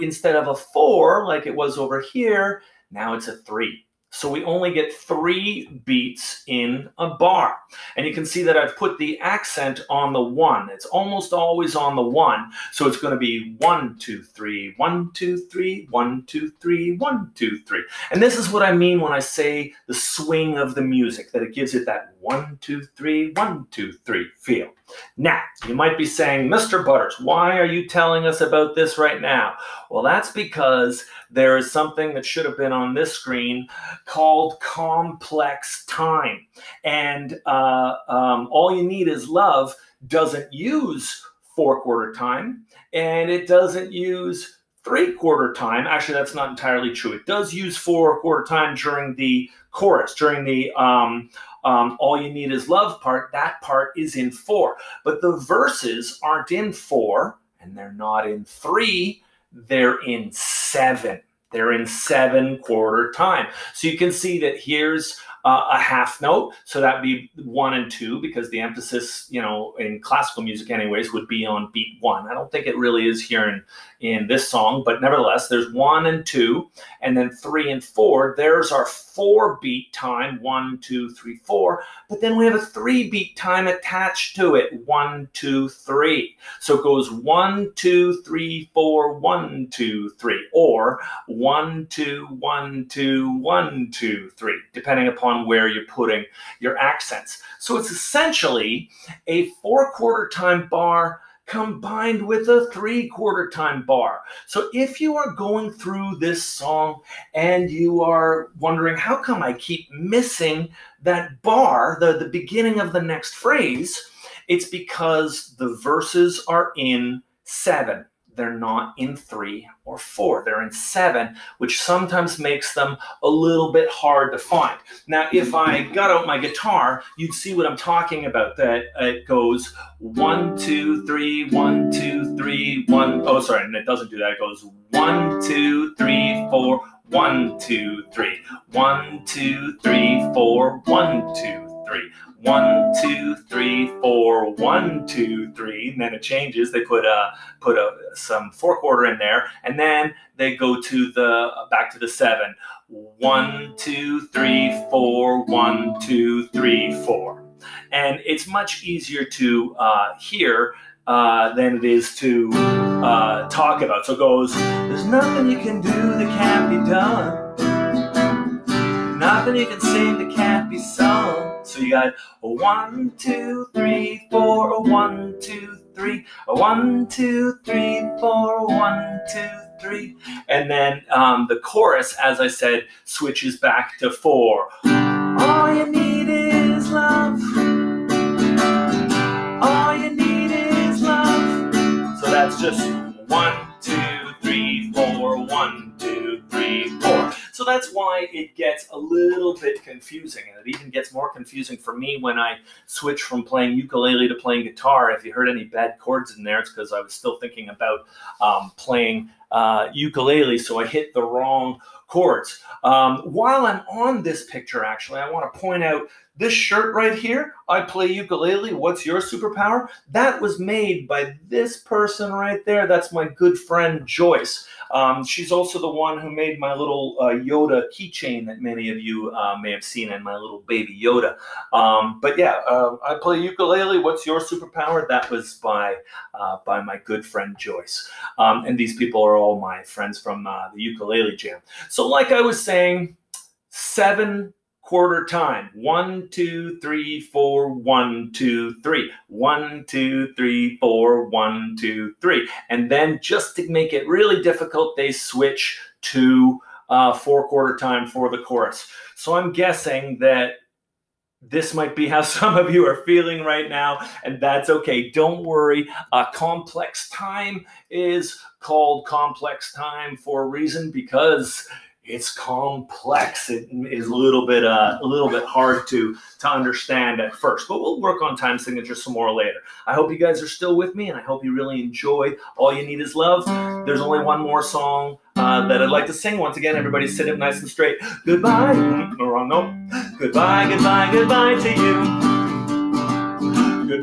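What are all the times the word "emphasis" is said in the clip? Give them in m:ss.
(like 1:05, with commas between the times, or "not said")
1:08.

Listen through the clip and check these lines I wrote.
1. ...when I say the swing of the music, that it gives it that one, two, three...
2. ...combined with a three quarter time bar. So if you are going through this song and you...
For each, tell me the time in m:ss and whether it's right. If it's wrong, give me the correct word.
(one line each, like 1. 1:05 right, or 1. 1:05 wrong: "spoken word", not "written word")
1. 0:19 right
2. 1:41 right.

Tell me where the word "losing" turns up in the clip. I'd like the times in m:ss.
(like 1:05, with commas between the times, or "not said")
not said.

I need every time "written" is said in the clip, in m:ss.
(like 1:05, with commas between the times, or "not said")
not said.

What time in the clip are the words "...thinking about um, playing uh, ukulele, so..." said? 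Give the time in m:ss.
3:27.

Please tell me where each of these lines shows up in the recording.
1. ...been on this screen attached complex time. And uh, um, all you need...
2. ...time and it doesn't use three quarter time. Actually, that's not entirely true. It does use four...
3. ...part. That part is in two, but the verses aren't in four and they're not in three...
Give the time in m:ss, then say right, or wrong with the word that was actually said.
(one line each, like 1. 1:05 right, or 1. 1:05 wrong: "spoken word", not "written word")
1. 0:32 wrong: "called", not "attached"
2. 0:42 right
3. 0:53 wrong: "four", not "two".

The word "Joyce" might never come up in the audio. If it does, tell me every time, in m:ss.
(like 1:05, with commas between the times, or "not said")
3:44, 3:57.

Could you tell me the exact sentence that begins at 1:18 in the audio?
There's our four beat time, one, two, three, four.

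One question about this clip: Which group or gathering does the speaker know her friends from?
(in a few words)
Ukulele Jam.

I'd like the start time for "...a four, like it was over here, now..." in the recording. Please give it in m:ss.
0:00.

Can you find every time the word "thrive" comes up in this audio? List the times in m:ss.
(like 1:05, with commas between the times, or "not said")
not said.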